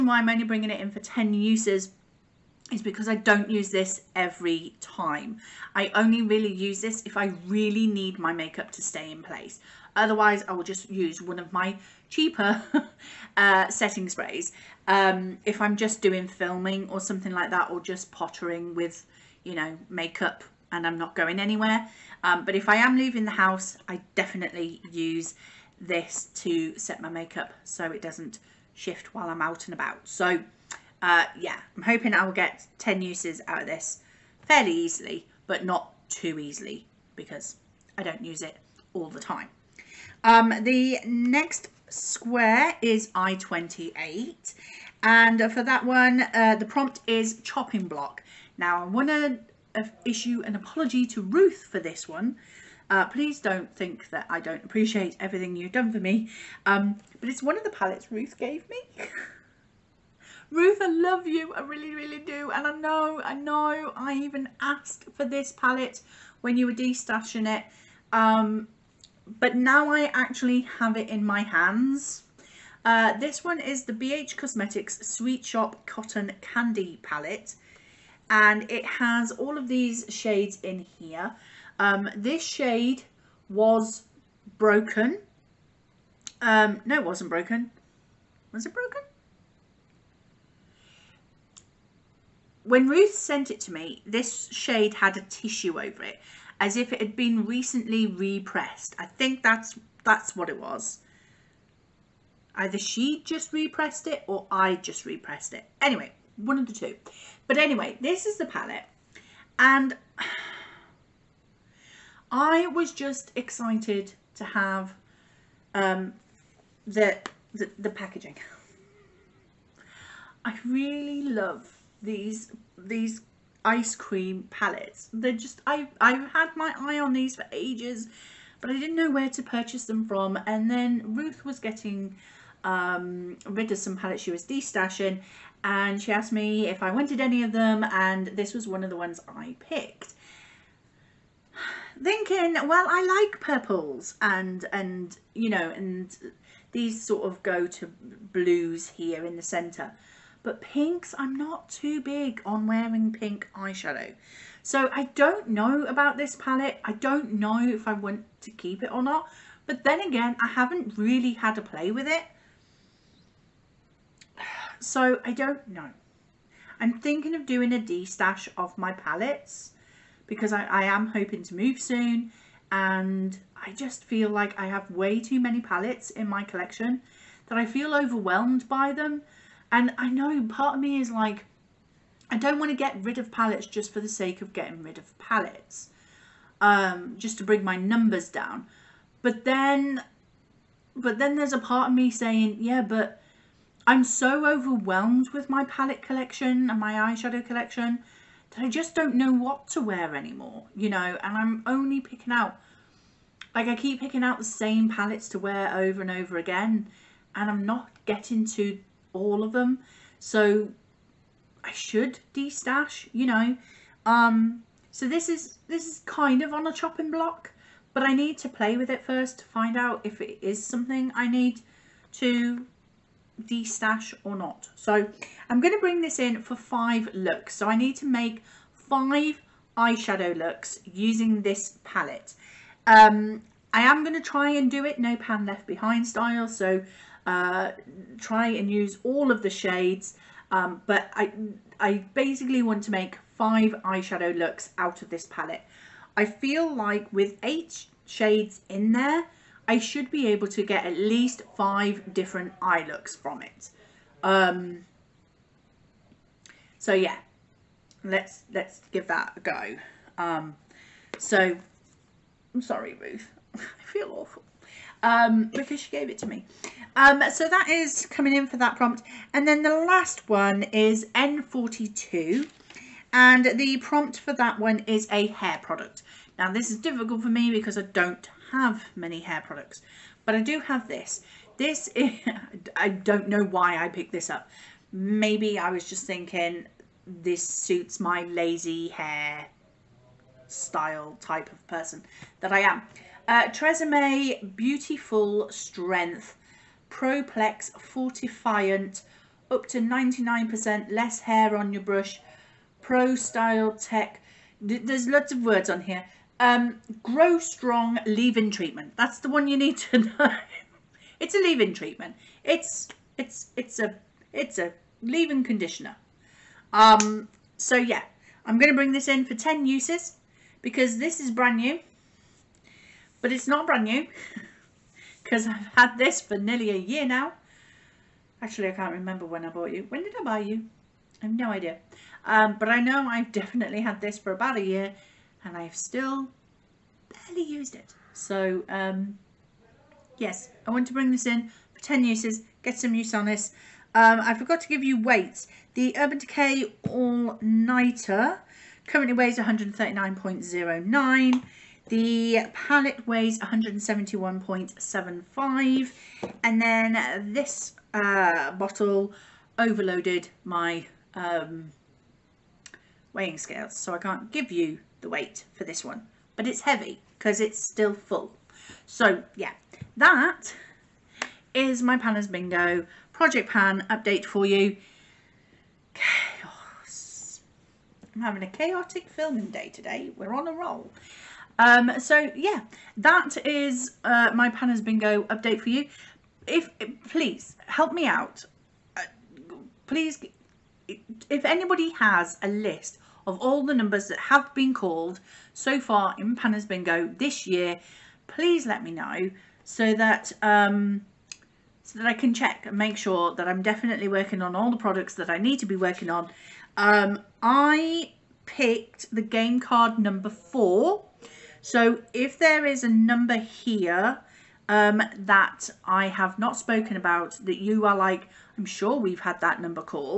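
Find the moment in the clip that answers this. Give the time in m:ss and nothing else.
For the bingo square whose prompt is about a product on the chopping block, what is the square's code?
0:43.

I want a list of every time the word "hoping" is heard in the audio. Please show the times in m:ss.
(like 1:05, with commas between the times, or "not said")
0:31, 2:51.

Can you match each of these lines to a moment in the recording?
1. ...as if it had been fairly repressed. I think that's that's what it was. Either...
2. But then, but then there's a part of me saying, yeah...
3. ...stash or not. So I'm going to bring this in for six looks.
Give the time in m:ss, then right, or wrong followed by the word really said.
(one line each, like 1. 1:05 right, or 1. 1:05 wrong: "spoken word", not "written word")
1. 1:36 wrong: "recently", not "fairly"
2. 3:09 right
3. 3:43 wrong: "five", not "six".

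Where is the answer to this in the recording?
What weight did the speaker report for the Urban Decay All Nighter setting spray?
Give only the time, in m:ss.
5:49.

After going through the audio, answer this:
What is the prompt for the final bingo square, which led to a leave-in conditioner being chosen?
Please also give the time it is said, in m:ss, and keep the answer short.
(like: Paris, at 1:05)
a hair product, at 4:35.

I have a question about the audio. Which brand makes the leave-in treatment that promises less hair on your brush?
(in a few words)
Tresemme.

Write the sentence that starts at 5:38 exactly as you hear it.
So um, yes, I want to bring this in for 10 uses, get some use on this.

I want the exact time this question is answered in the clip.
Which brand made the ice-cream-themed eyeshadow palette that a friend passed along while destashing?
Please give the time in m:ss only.
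1:13.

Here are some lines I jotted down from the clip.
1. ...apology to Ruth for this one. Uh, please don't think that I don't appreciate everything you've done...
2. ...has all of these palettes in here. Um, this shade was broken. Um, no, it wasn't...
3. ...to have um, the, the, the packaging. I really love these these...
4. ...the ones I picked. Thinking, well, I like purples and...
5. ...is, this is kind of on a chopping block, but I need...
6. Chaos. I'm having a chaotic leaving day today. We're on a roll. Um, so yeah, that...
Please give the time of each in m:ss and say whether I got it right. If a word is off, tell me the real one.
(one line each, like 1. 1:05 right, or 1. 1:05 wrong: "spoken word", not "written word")
1. 0:50 right
2. 1:18 wrong: "shades", not "palettes"
3. 1:54 right
4. 2:18 right
5. 3:35 right
6. 6:15 wrong: "filming", not "leaving".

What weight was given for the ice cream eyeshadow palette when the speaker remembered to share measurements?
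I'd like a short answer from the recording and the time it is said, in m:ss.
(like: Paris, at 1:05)
171.75, at 5:53.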